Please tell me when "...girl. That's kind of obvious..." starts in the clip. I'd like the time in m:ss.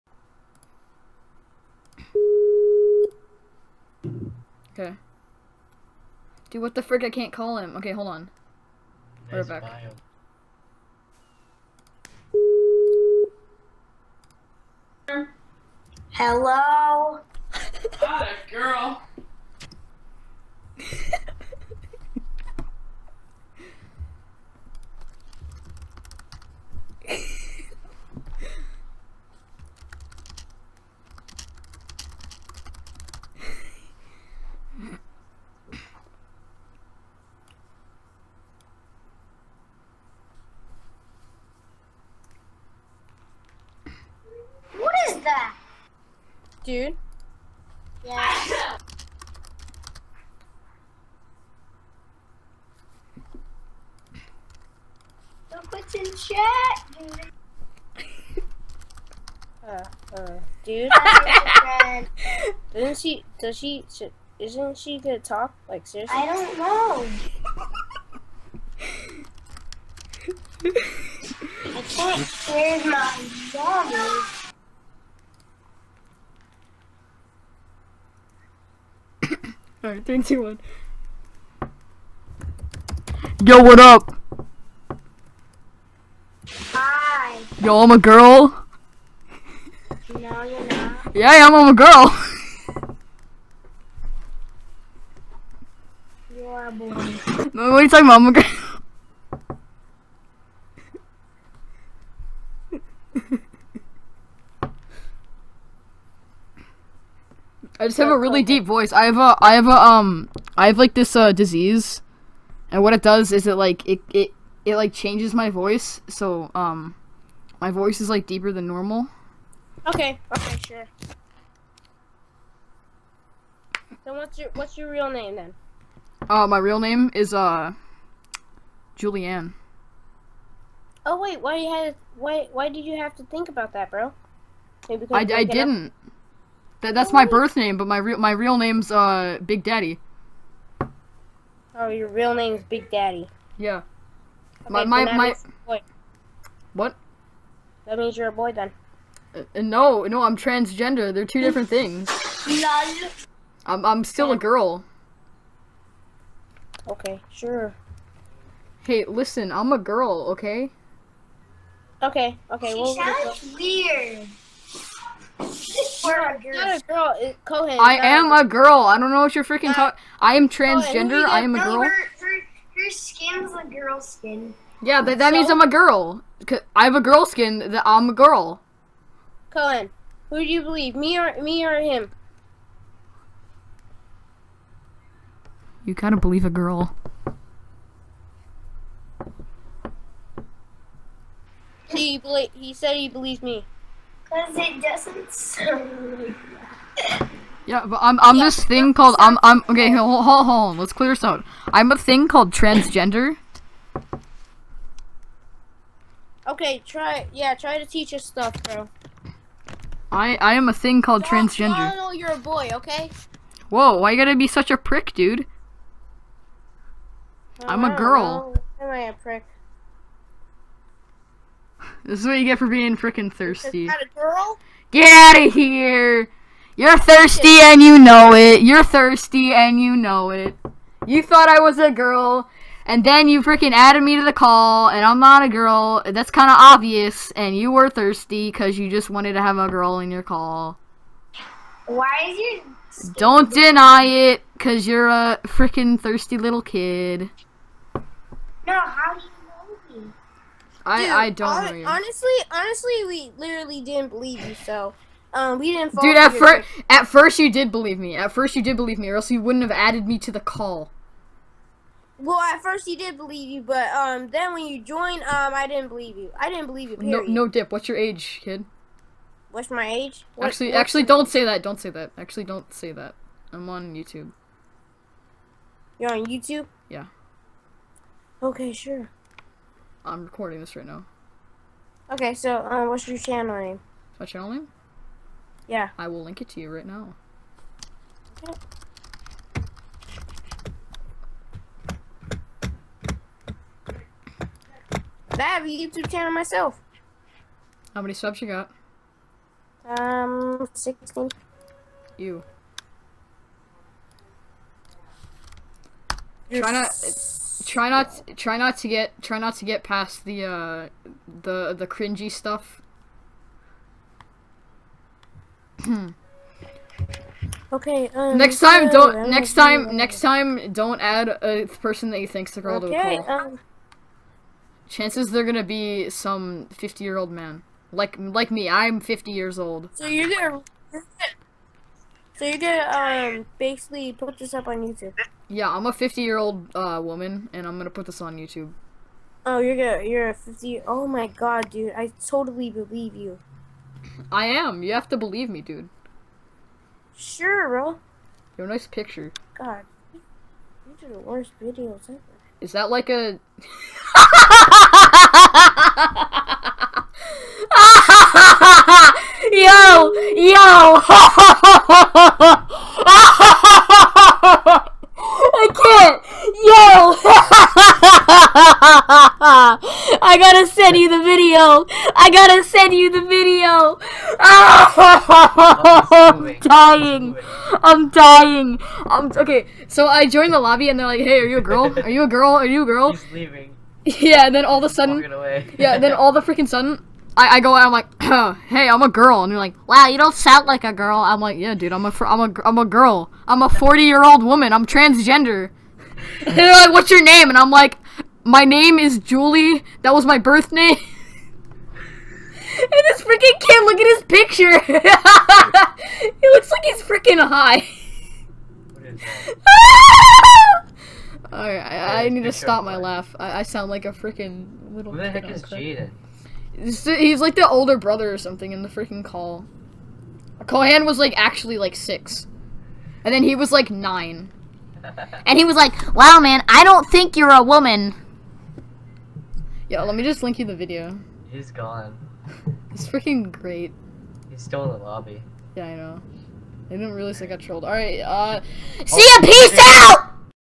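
3:55.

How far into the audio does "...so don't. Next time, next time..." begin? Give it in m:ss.
5:18.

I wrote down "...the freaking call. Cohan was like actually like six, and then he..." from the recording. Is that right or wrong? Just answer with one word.
right.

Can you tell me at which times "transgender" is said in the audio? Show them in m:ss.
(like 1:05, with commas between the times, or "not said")
2:30, 2:50, 3:22, 3:31, 6:34.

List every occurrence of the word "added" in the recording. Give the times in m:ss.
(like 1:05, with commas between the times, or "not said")
3:53, 4:19.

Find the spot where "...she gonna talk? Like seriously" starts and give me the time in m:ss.
1:04.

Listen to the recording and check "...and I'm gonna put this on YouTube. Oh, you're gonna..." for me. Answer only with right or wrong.
right.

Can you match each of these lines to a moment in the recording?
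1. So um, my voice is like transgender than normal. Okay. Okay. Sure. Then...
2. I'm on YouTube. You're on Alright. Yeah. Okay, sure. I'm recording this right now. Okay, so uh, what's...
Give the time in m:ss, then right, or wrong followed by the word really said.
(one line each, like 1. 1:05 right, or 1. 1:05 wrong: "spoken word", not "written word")
1. 1:56 wrong: "deeper", not "transgender"
2. 4:33 wrong: "YouTube", not "Alright".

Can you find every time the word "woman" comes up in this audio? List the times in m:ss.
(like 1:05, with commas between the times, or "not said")
5:37, 6:34, 7:07.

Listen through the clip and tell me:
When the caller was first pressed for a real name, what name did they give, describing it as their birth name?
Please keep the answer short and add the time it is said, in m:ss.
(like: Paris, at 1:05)
Julianne, at 2:08.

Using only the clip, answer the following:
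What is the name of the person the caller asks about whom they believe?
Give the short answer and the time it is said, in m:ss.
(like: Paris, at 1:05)
Cohen, at 2:59.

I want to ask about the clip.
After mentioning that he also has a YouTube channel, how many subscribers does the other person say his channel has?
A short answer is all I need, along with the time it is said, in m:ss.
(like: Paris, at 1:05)
16, at 5:00.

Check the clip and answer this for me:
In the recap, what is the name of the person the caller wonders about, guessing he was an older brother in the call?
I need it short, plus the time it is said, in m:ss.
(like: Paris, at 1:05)
Jaden, at 6:55.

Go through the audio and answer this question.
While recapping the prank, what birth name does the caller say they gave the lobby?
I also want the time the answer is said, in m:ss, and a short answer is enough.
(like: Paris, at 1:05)
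Julie, at 6:39.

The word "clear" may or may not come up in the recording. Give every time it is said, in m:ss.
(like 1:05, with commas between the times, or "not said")
3:20.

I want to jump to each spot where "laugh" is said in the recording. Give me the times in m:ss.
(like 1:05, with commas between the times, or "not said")
6:52.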